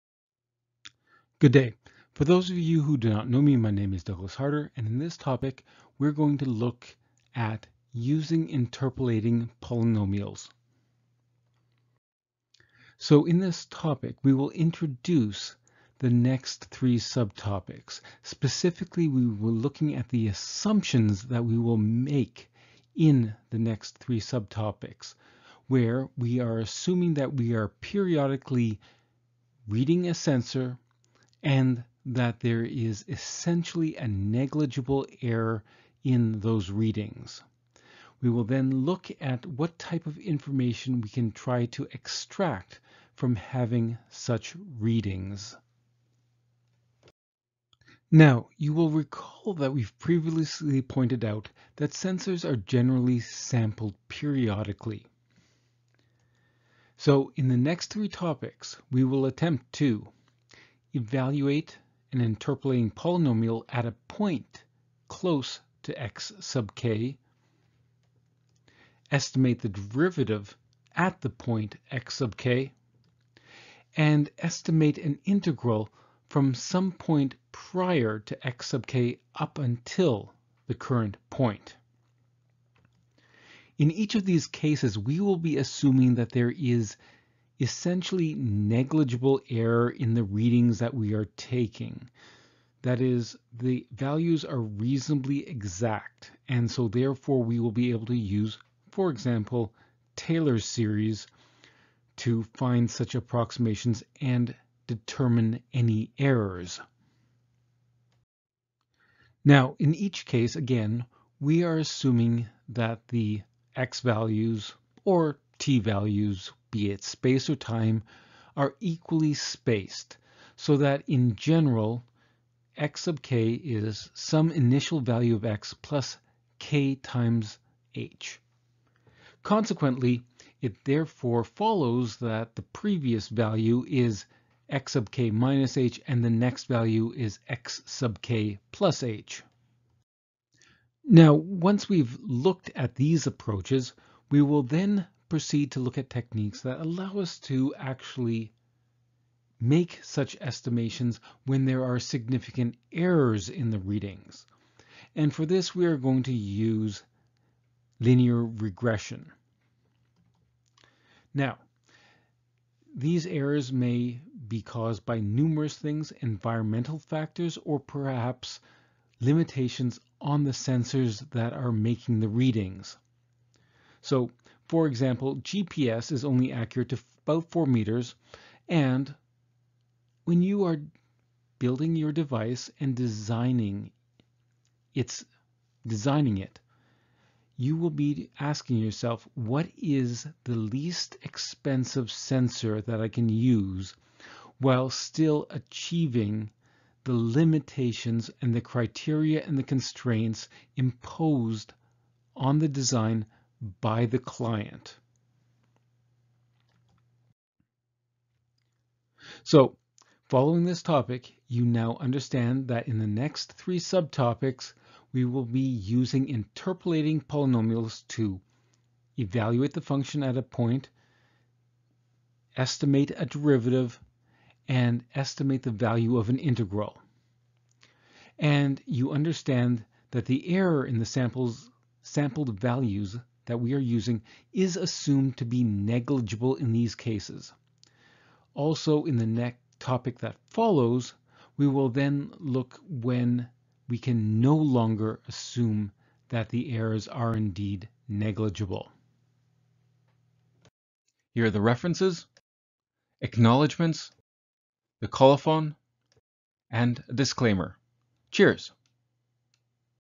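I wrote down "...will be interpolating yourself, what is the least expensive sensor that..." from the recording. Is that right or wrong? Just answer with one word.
wrong.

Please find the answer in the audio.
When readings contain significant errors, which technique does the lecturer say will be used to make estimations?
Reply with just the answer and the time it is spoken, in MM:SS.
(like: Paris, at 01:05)
linear regression, at 02:38.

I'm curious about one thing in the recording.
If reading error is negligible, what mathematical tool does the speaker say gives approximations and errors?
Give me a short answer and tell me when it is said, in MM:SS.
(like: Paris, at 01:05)
Taylor series, at 01:40.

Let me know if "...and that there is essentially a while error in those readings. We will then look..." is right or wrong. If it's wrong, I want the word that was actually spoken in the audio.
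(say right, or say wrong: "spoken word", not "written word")
wrong: "negligible", not "while".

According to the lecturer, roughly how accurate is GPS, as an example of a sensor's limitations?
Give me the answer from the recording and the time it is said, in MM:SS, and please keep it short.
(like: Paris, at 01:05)
4 meters, at 02:57.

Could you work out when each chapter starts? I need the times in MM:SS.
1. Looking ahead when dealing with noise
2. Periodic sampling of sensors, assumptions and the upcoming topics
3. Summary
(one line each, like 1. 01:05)
1. 02:20
2. 00:47
3. 03:28.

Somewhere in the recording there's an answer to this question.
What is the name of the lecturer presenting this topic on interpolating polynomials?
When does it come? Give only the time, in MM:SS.
00:04.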